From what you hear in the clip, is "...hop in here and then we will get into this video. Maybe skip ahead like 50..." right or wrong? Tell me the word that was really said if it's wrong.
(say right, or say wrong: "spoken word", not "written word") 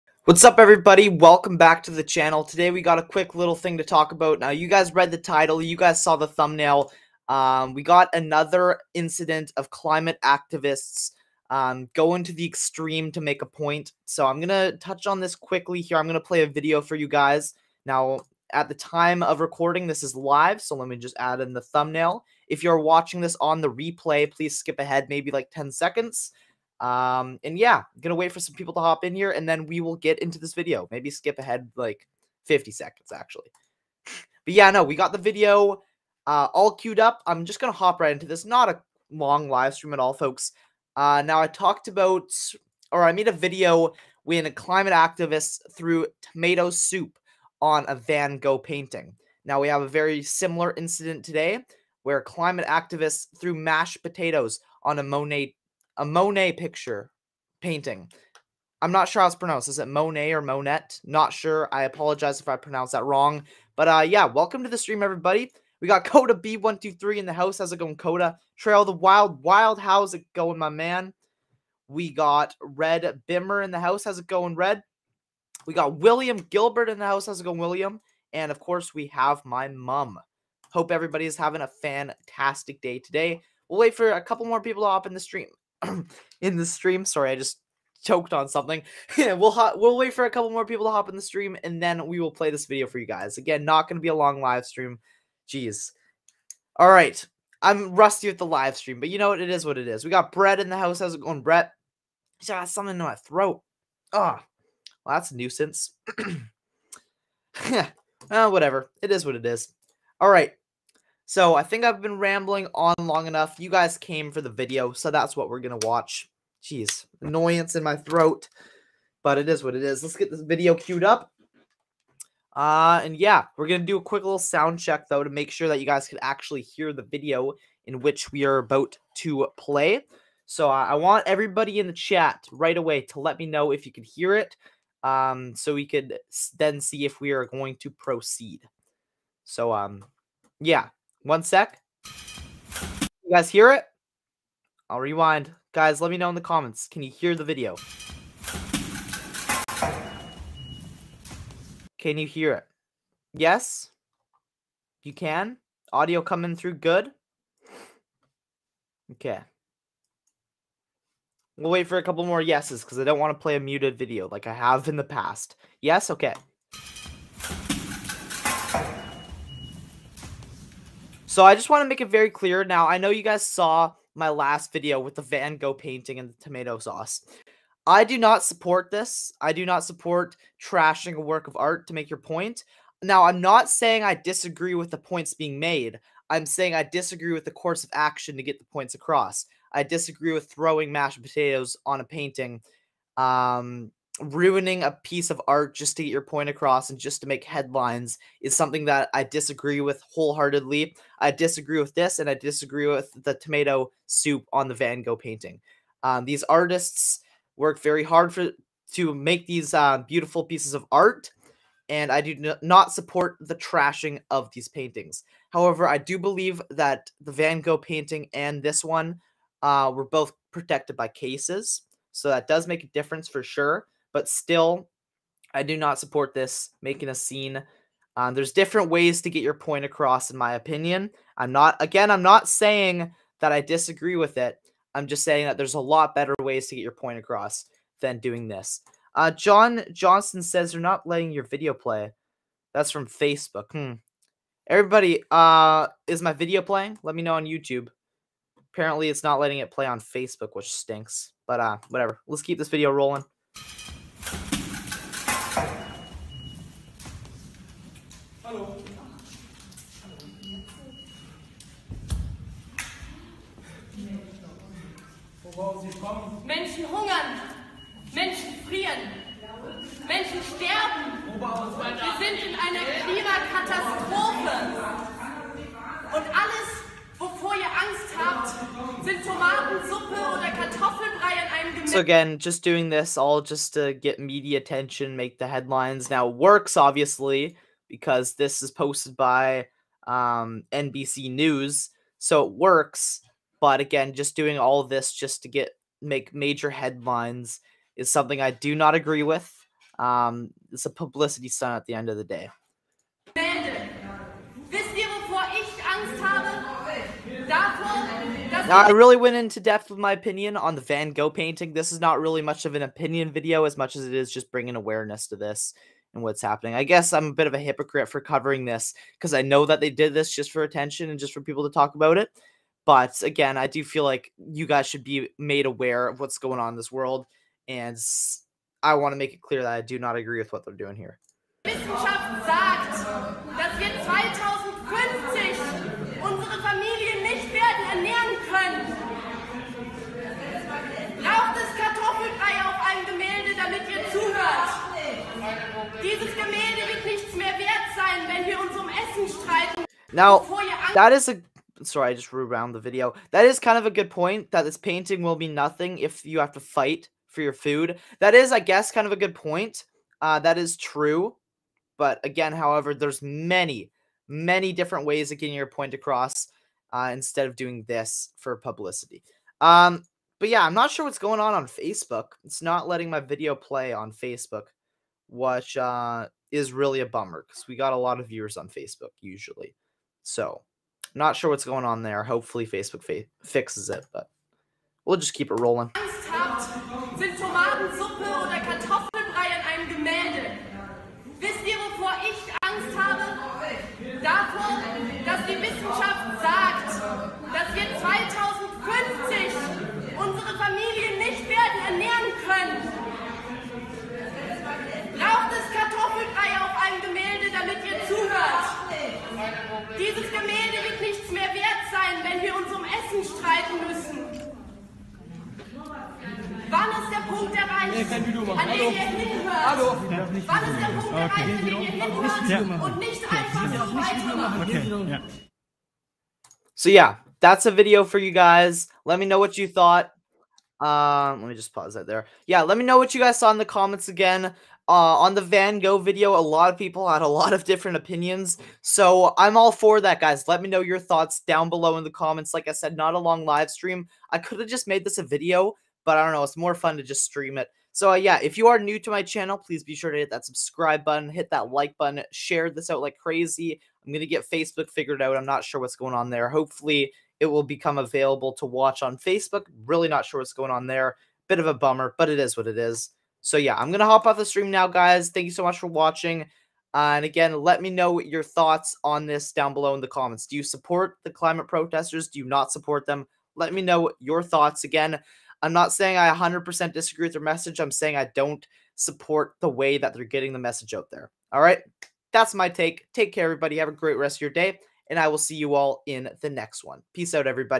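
right.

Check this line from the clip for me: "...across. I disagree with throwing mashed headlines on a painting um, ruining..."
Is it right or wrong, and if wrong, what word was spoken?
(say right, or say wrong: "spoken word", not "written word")
wrong: "potatoes", not "headlines".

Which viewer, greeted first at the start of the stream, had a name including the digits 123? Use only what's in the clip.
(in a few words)
Coda B123.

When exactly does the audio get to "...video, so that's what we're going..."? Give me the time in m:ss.
1:54.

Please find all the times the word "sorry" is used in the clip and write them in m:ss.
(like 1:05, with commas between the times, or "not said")
1:27, 5:51.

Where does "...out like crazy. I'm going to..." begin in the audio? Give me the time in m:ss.
7:32.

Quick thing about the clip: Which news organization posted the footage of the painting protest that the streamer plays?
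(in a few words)
NBC News.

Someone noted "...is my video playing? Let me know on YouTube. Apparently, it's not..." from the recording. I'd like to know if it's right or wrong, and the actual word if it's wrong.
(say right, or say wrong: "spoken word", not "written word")
right.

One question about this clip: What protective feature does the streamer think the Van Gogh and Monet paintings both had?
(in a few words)
Cases.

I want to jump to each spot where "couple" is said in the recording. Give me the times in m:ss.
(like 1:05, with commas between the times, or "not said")
1:24, 1:30, 2:42.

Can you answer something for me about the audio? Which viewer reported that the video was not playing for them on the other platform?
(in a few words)
John Johnson.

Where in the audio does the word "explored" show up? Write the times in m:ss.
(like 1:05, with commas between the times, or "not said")
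not said.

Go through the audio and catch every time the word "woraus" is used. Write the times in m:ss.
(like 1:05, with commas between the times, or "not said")
4:25.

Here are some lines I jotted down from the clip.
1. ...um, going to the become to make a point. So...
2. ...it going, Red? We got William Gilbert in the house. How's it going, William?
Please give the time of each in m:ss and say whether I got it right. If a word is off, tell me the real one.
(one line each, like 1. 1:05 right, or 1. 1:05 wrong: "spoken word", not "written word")
1. 0:11 wrong: "extreme", not "become"
2. 1:14 right.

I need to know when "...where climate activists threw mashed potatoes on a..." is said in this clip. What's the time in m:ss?
0:52.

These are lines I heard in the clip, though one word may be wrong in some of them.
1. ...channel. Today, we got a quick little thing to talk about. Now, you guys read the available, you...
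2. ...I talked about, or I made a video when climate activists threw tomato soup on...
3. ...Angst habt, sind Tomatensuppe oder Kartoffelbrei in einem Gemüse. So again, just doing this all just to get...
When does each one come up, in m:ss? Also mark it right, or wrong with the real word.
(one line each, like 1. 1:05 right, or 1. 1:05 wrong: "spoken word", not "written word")
1. 0:02 wrong: "title", not "available"
2. 0:41 right
3. 4:37 right.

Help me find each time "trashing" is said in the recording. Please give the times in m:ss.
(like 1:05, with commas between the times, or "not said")
3:00, 3:33.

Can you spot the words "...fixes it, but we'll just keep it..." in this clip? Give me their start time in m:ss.
6:23.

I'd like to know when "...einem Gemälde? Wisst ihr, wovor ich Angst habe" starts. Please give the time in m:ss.
6:29.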